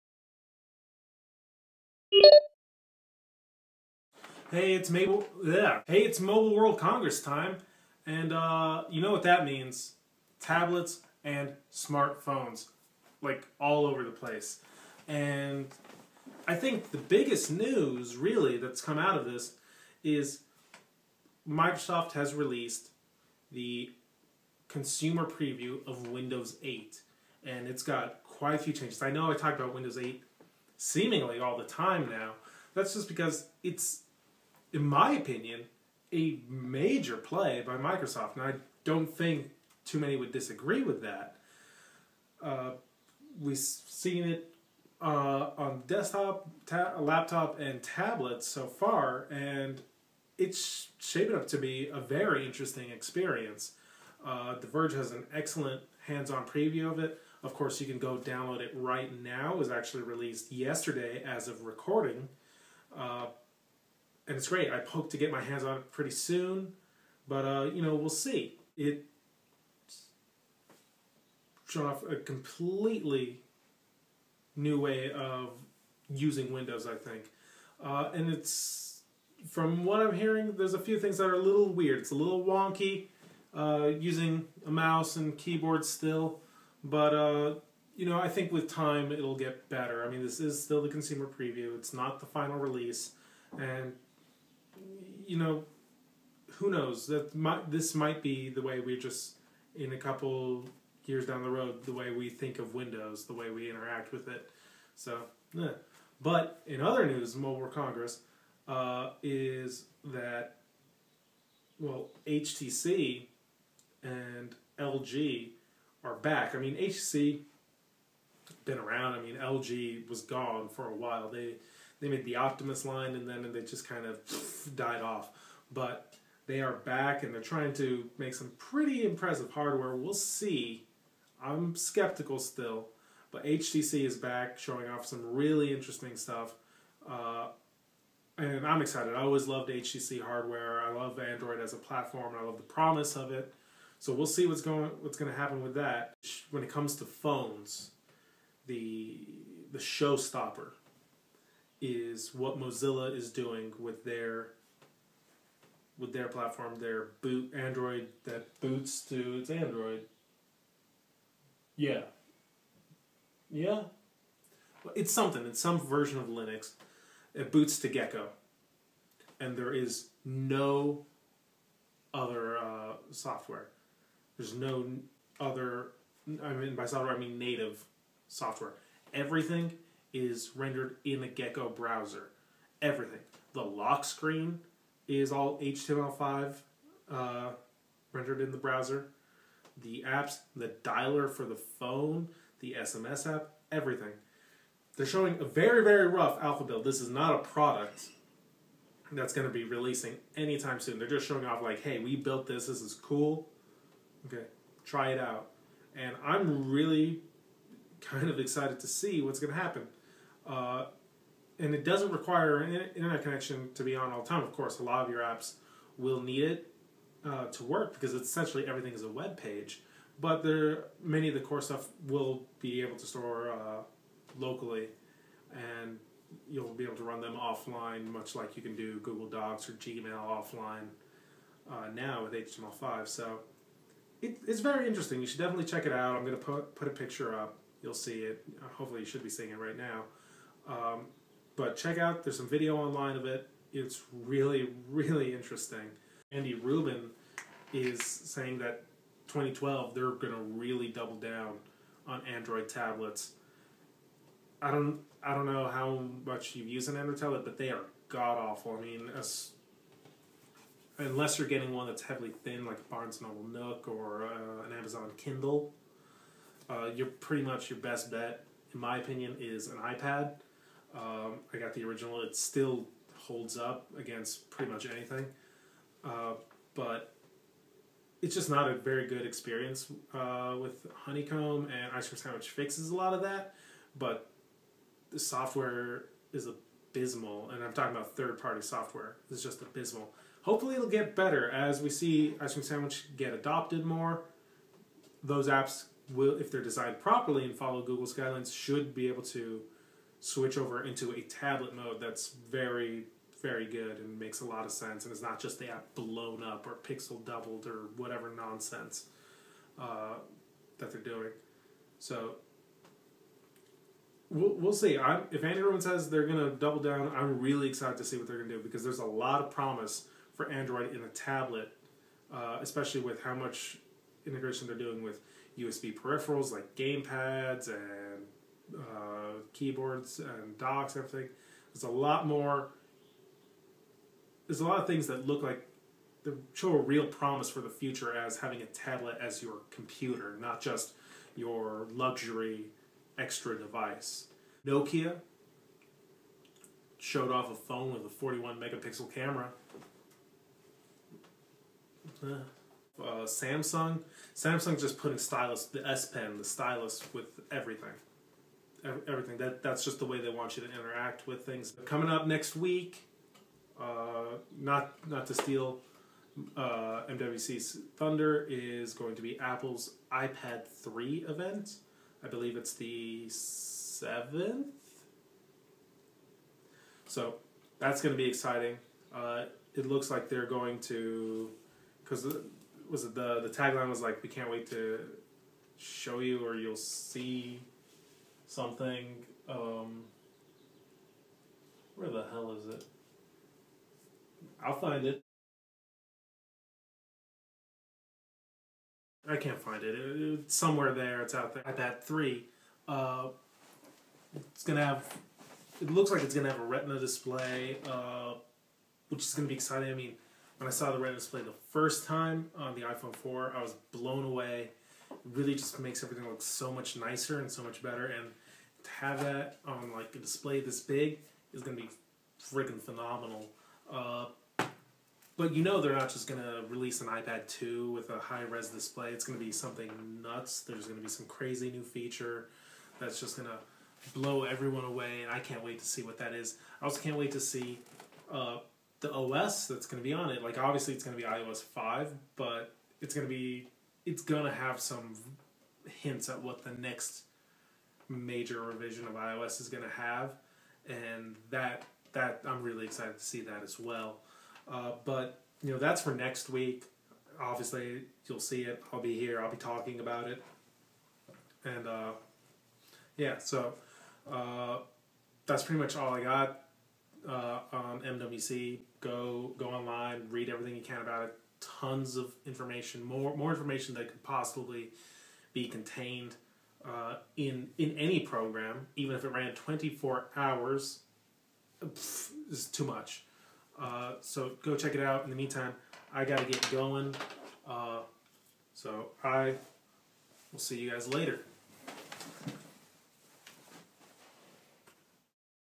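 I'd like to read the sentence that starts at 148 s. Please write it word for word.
The the showstopper is what Mozilla is doing with their with their platform, their boot Android that boots to its Android.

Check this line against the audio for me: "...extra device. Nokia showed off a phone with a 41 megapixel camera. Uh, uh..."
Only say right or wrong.
right.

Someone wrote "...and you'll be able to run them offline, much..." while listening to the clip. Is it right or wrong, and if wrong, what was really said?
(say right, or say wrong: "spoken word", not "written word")
right.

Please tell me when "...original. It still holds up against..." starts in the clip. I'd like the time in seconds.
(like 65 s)
271 s.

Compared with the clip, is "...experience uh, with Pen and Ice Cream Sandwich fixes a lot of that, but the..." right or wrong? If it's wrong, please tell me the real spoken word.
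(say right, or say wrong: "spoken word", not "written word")
wrong: "Honeycomb", not "Pen".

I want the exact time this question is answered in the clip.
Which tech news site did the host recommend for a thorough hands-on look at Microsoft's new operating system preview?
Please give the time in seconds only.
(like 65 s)
54 s.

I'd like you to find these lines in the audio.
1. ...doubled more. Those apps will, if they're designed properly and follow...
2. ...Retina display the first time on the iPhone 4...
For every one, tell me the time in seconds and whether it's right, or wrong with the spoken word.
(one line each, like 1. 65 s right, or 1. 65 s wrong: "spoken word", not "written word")
1. 293 s wrong: "adopted", not "doubled"
2. 410 s right.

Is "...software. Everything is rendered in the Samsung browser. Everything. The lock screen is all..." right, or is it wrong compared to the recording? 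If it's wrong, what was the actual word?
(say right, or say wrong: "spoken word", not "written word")
wrong: "Gecko", not "Samsung".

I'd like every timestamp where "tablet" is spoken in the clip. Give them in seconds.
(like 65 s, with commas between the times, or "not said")
10 s, 47 s, 252 s, 257 s, 301 s, 321 s, 338 s.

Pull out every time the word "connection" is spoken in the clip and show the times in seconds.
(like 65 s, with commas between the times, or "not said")
213 s.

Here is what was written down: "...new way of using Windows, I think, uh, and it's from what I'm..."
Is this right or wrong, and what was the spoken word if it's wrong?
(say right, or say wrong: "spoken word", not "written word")
right.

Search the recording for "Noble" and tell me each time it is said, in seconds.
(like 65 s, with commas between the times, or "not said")
263 s.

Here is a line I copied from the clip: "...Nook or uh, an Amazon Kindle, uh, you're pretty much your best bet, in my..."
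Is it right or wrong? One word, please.
right.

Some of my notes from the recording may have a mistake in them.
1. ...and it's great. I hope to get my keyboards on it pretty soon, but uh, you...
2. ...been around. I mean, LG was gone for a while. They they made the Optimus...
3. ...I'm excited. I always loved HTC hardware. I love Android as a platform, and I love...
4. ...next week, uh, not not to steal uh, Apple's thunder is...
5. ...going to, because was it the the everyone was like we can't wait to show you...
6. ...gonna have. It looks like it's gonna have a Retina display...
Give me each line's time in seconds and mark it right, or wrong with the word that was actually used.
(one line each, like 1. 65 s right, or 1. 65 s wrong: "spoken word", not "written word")
1. 64 s wrong: "hands", not "keyboards"
2. 118 s right
3. 138 s right
4. 362 s wrong: "MWC", not "Apple"
5. 380 s wrong: "tagline", not "everyone"
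6. 404 s right.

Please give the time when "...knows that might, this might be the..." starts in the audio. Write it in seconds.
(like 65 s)
96 s.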